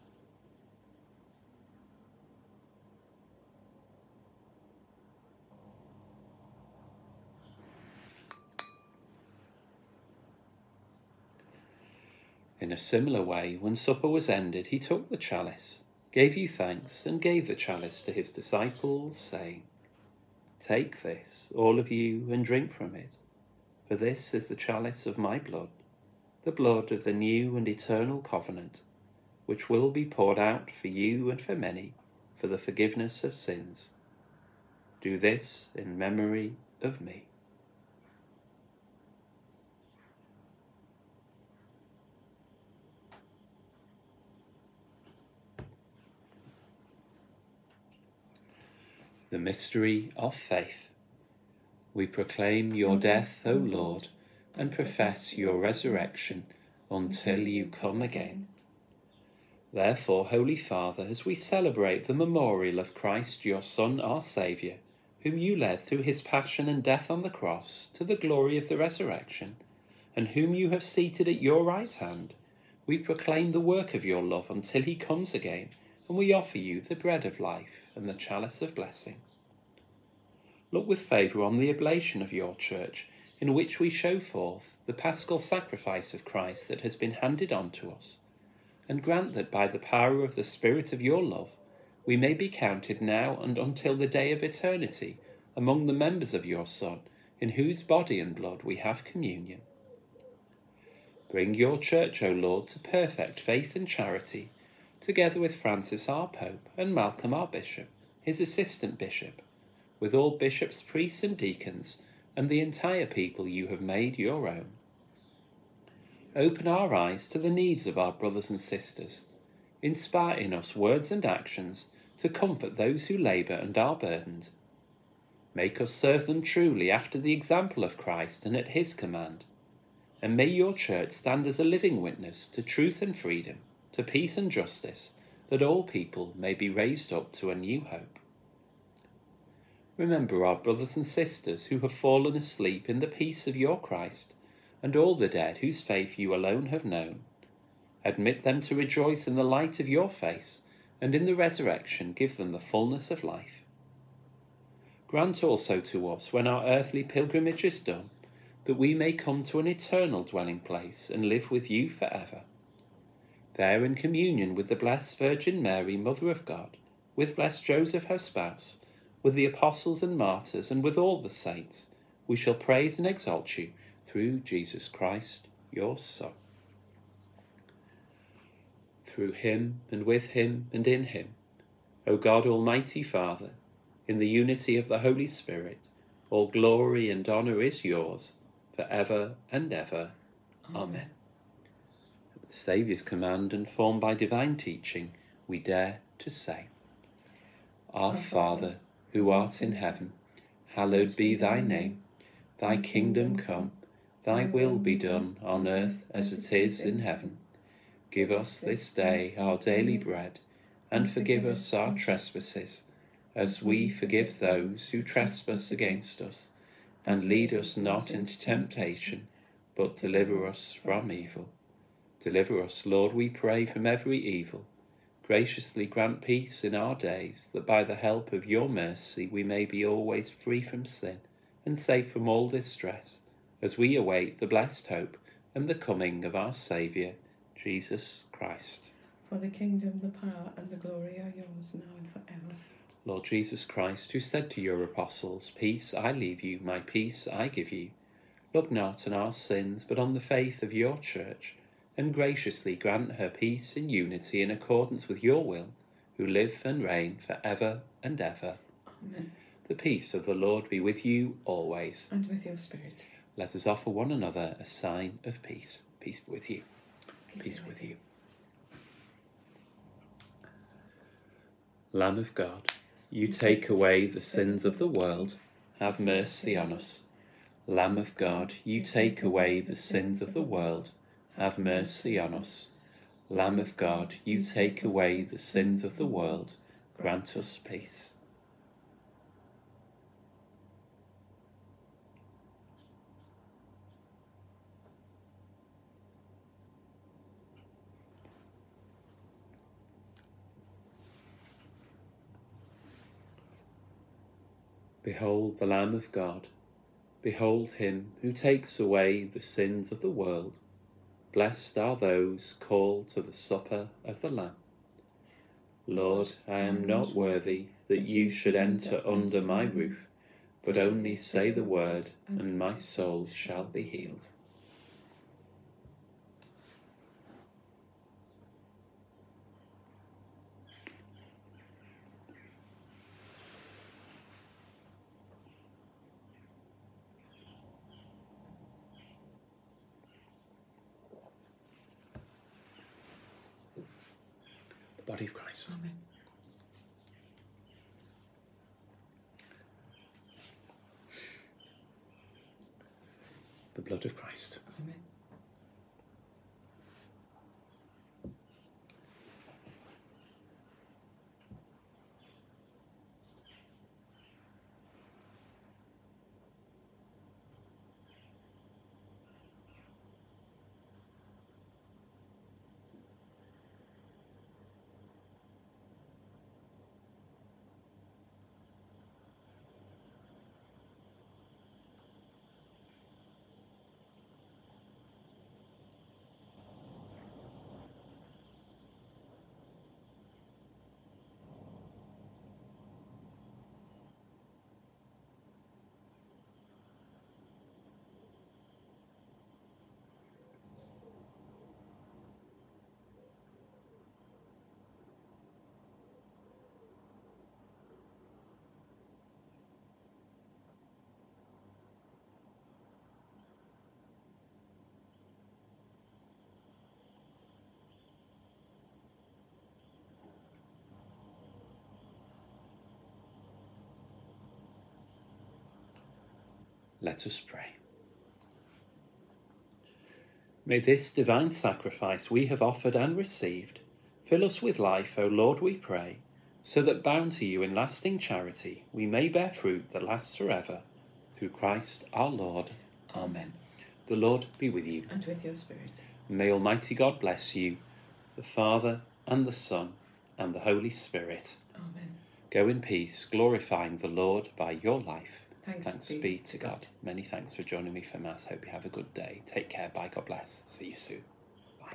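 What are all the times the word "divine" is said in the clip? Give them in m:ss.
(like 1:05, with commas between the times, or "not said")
3:14, 7:11.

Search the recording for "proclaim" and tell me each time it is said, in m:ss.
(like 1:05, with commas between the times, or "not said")
0:52, 1:12.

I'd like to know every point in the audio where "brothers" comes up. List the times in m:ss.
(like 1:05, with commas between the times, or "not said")
1:58, 2:20.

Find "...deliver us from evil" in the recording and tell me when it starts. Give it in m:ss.
3:39.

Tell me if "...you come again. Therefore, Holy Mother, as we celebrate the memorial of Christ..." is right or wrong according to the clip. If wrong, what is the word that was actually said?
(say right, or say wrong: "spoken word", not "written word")
wrong: "Father", not "Mother".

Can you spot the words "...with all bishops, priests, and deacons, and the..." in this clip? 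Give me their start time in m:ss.
1:49.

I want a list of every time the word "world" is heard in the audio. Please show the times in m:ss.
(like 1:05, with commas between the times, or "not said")
4:34, 4:40, 4:46, 5:10.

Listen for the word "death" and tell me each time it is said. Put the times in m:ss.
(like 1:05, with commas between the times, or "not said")
0:52, 1:06.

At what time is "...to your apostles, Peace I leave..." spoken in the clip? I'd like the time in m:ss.
4:04.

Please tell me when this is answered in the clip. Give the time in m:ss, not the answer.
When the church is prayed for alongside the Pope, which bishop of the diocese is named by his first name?
1:46.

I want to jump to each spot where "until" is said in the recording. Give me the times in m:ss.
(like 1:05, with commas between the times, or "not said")
0:56, 1:14, 1:33.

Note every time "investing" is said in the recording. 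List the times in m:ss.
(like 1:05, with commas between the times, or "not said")
not said.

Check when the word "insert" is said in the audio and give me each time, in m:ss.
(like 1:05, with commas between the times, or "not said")
not said.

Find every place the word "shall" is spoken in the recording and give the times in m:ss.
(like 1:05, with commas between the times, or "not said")
2:52, 5:23.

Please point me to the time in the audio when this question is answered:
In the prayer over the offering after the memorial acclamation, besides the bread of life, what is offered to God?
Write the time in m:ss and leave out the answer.
1:18.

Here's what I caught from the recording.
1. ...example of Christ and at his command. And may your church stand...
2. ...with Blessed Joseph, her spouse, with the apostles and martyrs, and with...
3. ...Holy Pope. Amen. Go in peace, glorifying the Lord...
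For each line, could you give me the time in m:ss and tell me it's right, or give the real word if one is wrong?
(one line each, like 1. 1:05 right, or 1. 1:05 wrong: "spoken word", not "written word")
1. 2:07 right
2. 2:47 right
3. 7:30 wrong: "Spirit", not "Pope".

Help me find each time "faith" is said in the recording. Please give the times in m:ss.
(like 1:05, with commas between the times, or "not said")
0:50, 1:43, 2:25, 4:10.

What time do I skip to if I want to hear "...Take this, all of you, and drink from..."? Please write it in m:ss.
0:20.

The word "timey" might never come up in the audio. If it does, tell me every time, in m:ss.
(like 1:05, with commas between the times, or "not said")
not said.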